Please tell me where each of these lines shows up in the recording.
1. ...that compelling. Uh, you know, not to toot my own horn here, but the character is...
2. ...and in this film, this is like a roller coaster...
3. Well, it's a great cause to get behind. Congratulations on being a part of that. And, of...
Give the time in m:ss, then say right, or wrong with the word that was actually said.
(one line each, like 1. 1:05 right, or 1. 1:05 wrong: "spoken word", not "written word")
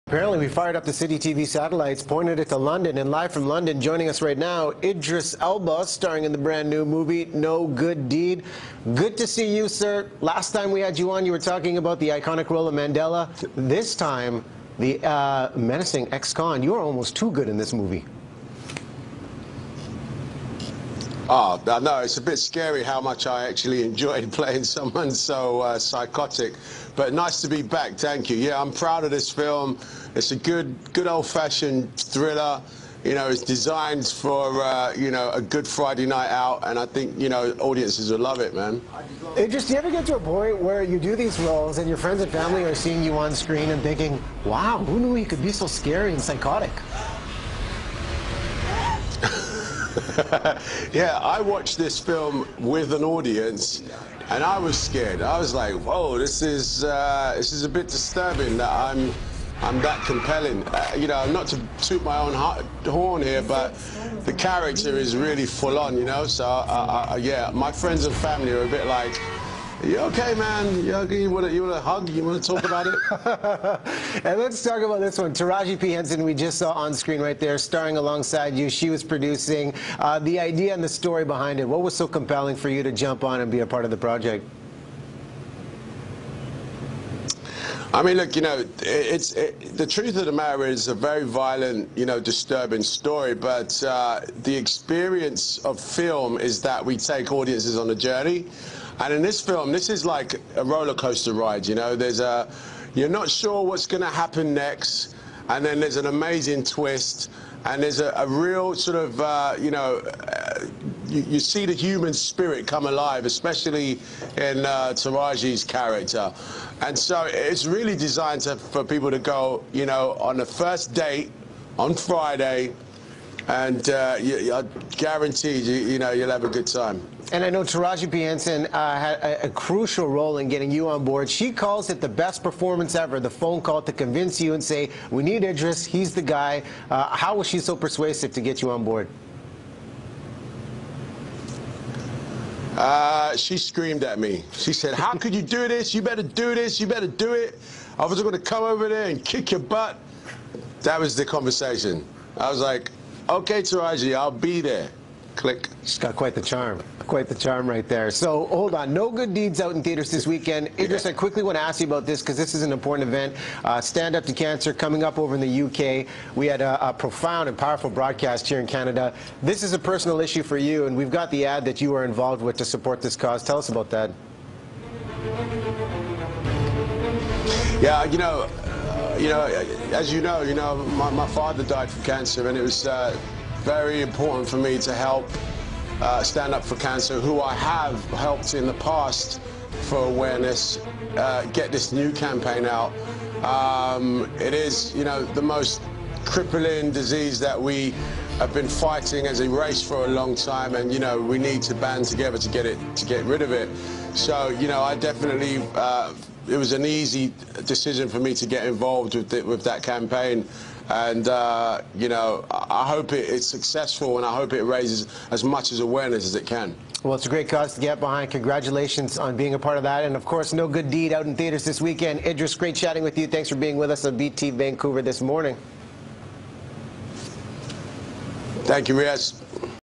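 1. 0:59 right
2. 1:38 right
3. 3:37 right.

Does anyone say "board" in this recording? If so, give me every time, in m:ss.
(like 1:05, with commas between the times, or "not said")
2:11, 2:18.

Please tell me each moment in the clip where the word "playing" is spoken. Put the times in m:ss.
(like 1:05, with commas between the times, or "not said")
0:24.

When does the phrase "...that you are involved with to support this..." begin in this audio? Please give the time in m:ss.
2:51.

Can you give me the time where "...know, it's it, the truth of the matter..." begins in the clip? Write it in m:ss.
1:28.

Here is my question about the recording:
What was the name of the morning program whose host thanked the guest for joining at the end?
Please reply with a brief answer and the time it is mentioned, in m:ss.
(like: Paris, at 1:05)
BT Vancouver, at 3:44.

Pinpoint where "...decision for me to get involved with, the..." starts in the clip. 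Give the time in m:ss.
3:27.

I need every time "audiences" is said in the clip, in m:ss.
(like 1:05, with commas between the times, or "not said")
0:37, 0:53, 1:37.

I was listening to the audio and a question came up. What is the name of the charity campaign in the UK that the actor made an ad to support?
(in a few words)
Stand Up to Cancer.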